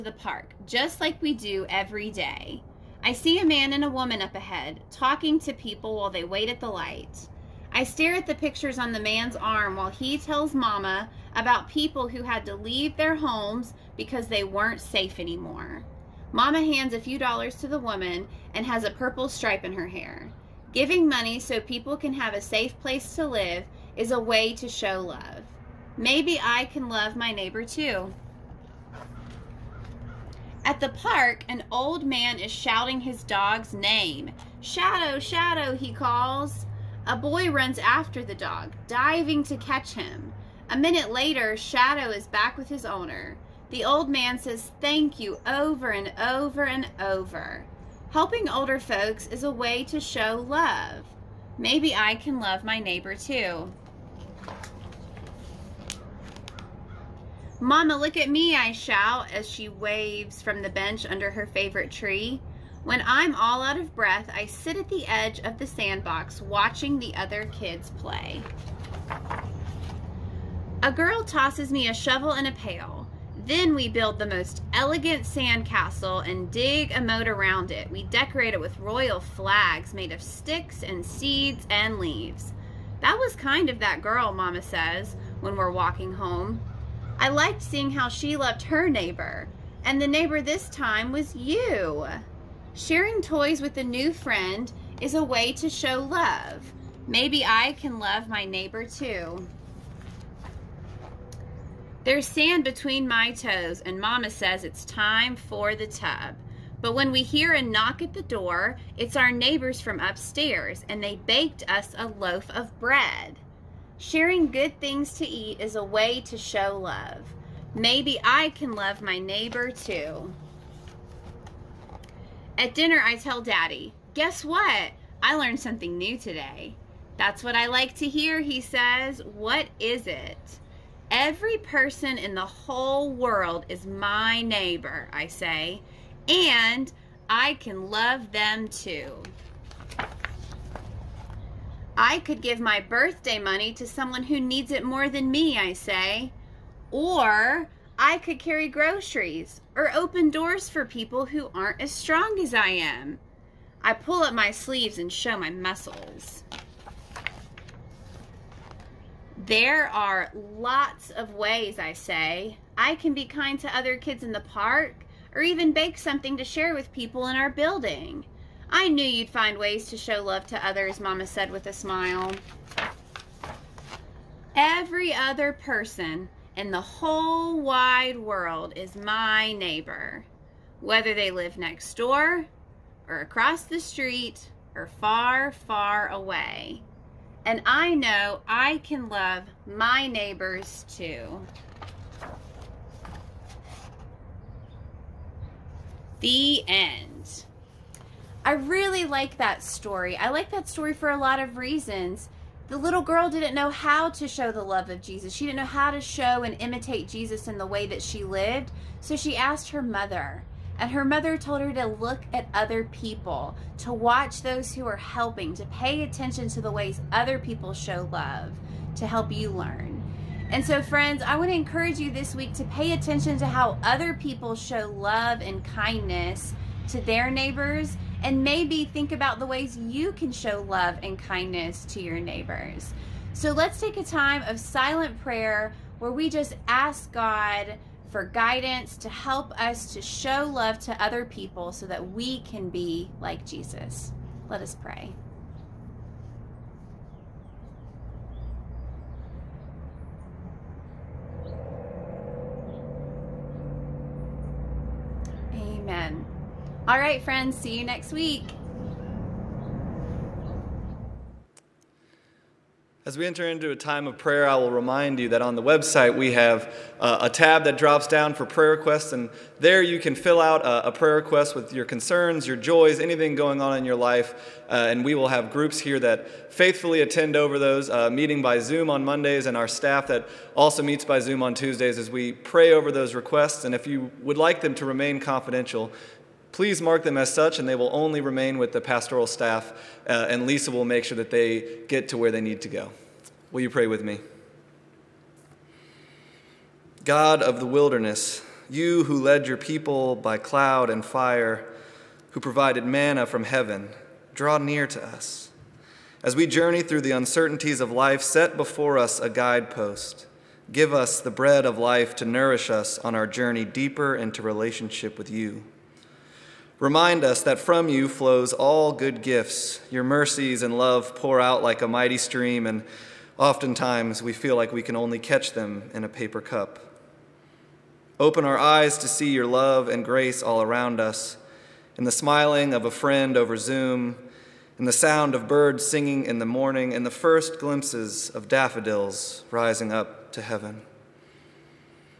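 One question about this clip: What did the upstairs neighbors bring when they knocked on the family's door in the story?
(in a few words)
A loaf of bread.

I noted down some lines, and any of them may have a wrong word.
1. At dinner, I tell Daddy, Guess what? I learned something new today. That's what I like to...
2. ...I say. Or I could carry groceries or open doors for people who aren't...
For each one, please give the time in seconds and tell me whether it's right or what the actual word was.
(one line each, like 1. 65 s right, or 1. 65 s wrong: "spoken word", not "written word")
1. 122 s right
2. 145 s right.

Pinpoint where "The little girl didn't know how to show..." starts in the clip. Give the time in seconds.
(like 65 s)
202 s.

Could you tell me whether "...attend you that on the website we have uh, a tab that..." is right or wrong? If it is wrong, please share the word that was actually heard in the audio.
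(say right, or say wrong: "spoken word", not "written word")
wrong: "remind", not "attend".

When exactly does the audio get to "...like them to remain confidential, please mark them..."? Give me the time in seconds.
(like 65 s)
284 s.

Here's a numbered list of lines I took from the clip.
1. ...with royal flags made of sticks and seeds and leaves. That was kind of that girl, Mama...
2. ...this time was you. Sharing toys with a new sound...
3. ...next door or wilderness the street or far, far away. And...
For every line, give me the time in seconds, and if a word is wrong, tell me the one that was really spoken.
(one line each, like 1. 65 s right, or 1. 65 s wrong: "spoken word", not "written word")
1. 78 s right
2. 90 s wrong: "friend", not "sound"
3. 181 s wrong: "across", not "wilderness".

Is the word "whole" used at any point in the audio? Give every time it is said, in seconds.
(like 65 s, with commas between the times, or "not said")
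132 s, 176 s.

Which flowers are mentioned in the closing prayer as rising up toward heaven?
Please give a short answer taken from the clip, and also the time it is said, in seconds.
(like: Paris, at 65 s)
Daffodils, at 338 s.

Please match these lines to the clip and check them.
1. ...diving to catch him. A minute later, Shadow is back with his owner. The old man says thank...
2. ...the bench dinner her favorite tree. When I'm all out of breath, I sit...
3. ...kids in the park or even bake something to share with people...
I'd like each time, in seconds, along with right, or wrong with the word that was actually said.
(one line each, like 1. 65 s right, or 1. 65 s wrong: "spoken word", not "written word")
1. 38 s right
2. 60 s wrong: "under", not "dinner"
3. 163 s right.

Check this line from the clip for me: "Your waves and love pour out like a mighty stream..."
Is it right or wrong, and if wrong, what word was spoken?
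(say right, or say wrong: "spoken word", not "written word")
wrong: "mercies", not "waves".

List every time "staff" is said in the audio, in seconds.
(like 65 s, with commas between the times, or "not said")
279 s, 289 s.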